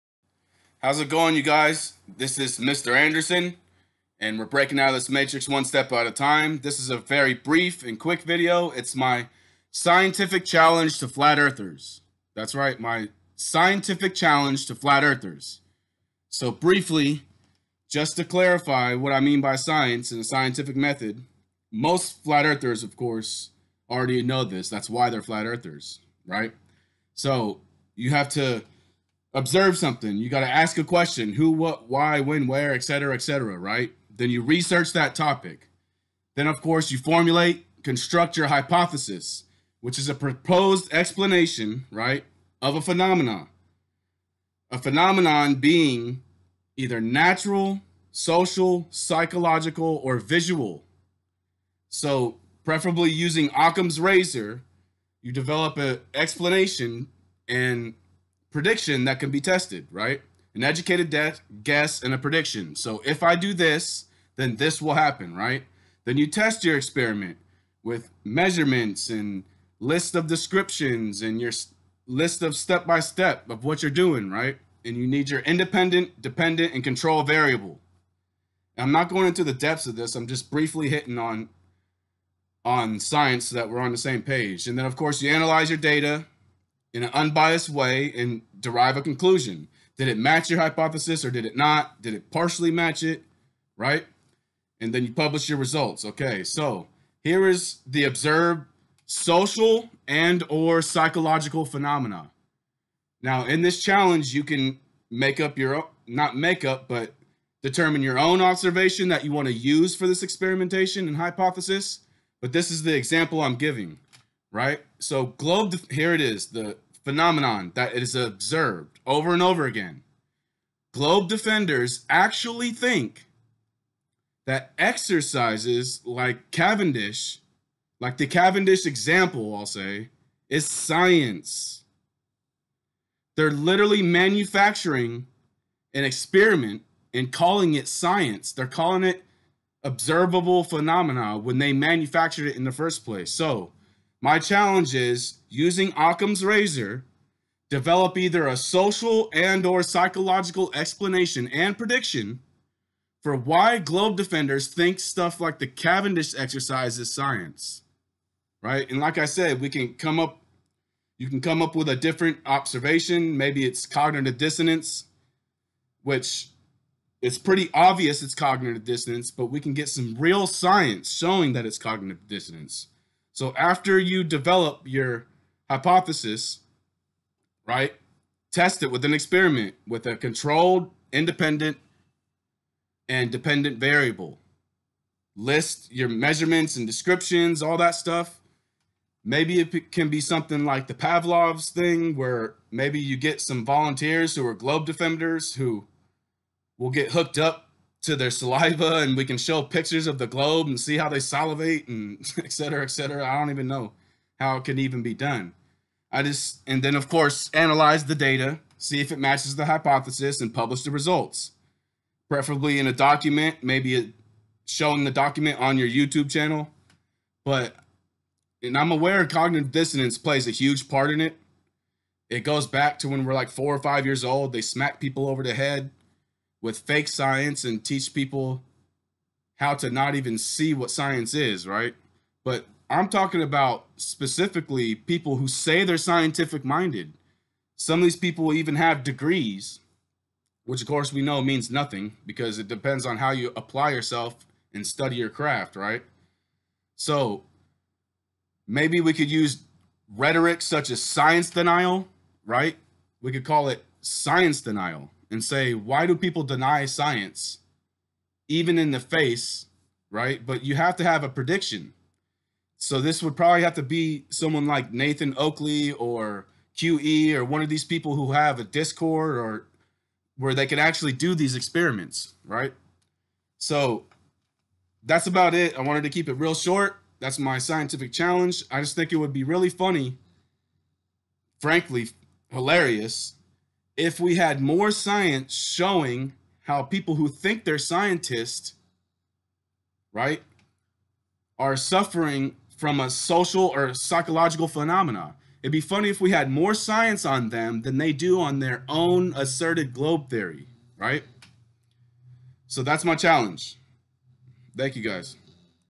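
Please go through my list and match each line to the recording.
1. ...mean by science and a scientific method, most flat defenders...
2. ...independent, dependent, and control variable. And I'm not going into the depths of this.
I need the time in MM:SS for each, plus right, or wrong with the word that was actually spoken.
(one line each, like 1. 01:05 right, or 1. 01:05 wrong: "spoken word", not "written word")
1. 00:19 wrong: "earthers", not "defenders"
2. 01:15 right.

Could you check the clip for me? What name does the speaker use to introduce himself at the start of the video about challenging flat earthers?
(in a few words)
Mr. Anderson.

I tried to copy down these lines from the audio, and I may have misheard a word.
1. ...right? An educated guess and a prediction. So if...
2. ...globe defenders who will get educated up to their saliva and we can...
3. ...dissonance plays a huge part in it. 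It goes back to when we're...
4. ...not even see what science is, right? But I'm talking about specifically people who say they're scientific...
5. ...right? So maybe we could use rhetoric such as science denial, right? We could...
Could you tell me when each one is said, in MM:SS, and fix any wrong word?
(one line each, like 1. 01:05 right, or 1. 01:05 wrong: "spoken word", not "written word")
1. 00:59 right
2. 03:14 wrong: "hooked", not "educated"
3. 03:39 right
4. 03:49 right
5. 04:05 right.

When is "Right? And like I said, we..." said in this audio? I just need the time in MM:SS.
02:38.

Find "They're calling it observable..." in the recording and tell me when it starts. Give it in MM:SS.
02:18.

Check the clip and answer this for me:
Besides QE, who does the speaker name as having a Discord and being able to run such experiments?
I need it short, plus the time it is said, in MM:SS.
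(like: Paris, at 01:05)
Nathan Oakley, at 04:24.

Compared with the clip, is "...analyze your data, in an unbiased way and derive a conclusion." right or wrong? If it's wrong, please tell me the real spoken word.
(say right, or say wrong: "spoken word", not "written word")
right.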